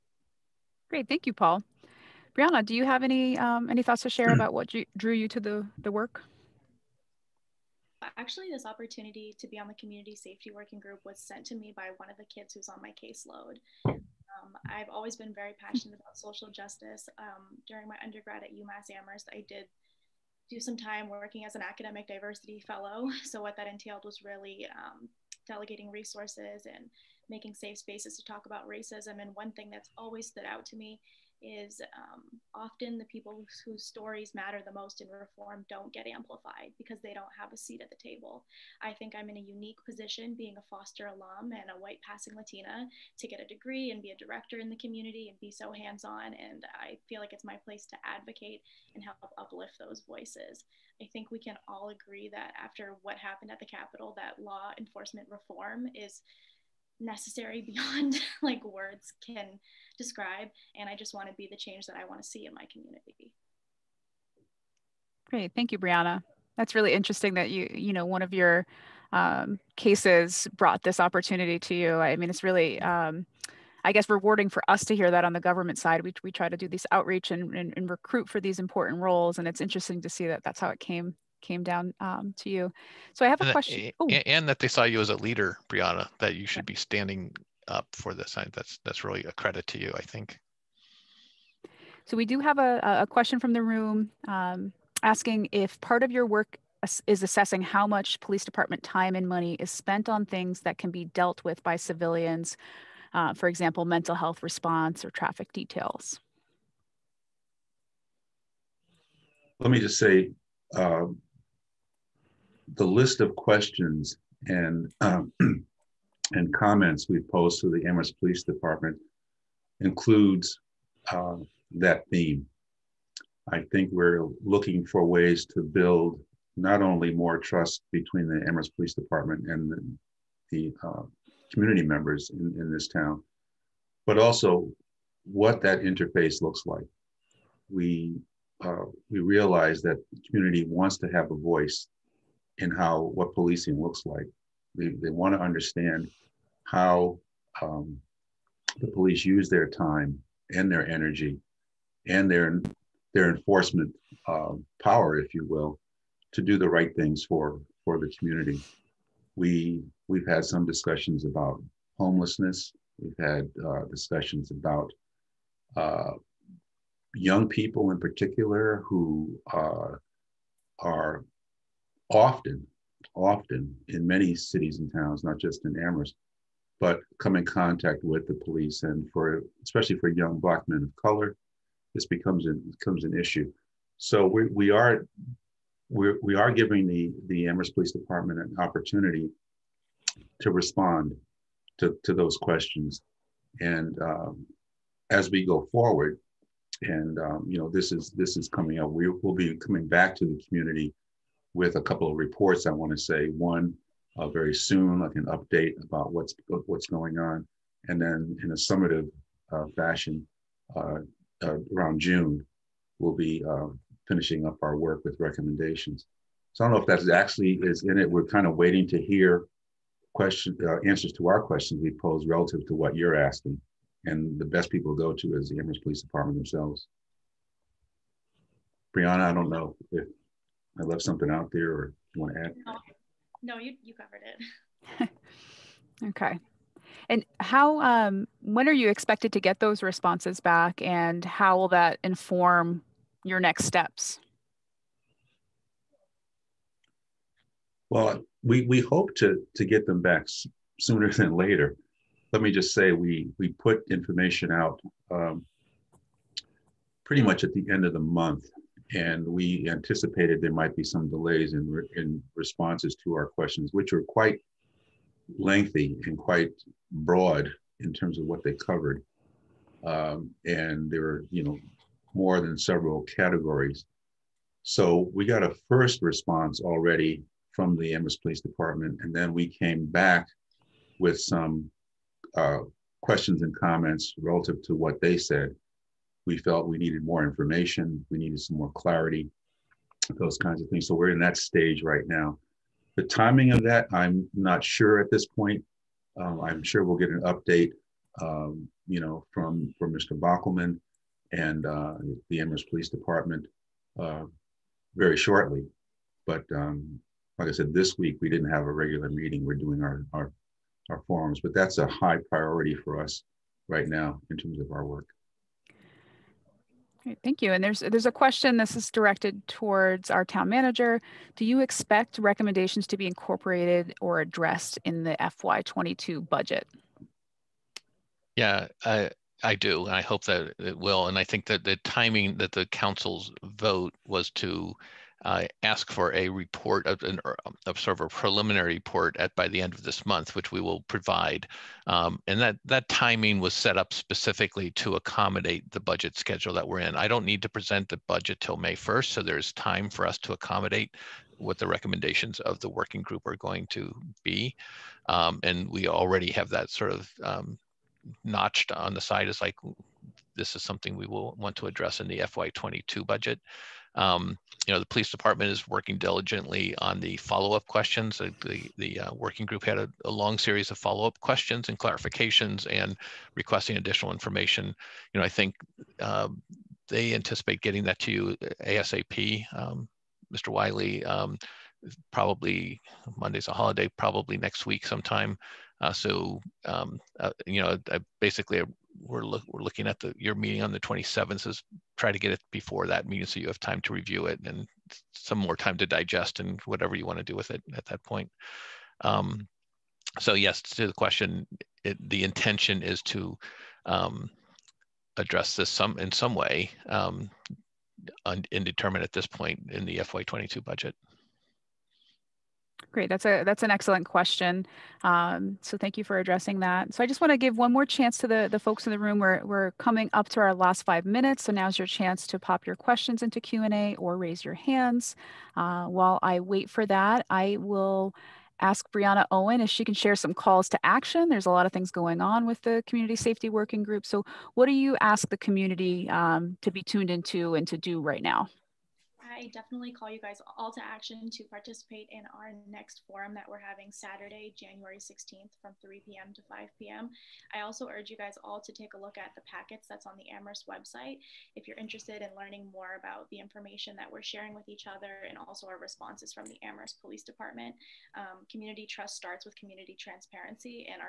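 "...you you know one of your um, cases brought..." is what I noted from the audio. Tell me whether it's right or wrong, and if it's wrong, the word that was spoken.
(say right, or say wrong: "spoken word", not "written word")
right.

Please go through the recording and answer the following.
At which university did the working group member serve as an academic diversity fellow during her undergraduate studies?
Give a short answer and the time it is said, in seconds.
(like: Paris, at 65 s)
UMass Amherst, at 18 s.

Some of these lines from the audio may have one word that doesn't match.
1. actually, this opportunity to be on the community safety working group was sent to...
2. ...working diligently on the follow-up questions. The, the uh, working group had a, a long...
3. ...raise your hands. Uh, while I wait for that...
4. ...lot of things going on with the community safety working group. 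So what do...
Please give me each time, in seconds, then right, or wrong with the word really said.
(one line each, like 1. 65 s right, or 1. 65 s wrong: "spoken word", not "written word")
1. 8 s right
2. 365 s right
3. 424 s right
4. 431 s right.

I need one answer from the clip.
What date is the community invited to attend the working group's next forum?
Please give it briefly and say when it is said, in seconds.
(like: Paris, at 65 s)
January 16th, at 444 s.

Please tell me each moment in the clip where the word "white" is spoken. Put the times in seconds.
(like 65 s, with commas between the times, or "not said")
41 s.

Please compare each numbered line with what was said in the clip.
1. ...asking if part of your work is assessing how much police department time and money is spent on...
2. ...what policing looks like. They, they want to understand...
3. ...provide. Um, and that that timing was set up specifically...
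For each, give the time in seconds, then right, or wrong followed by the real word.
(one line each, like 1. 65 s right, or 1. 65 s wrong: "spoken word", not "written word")
1. 95 s right
2. 143 s right
3. 340 s right.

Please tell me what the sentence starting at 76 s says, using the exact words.
We, we try to do this outreach and, and, and, recruit for these important roles.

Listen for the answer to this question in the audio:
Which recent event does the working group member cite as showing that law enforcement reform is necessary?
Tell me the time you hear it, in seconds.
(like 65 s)
53 s.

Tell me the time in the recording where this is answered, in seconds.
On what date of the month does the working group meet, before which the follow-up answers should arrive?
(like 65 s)
390 s.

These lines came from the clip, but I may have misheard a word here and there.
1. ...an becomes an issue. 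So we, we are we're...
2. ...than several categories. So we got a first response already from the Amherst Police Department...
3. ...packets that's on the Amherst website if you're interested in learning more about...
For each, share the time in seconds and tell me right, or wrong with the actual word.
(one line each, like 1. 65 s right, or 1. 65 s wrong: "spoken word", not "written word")
1. 182 s right
2. 272 s right
3. 449 s right.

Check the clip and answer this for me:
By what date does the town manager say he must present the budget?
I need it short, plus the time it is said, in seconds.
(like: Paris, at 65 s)
May 1st, at 348 s.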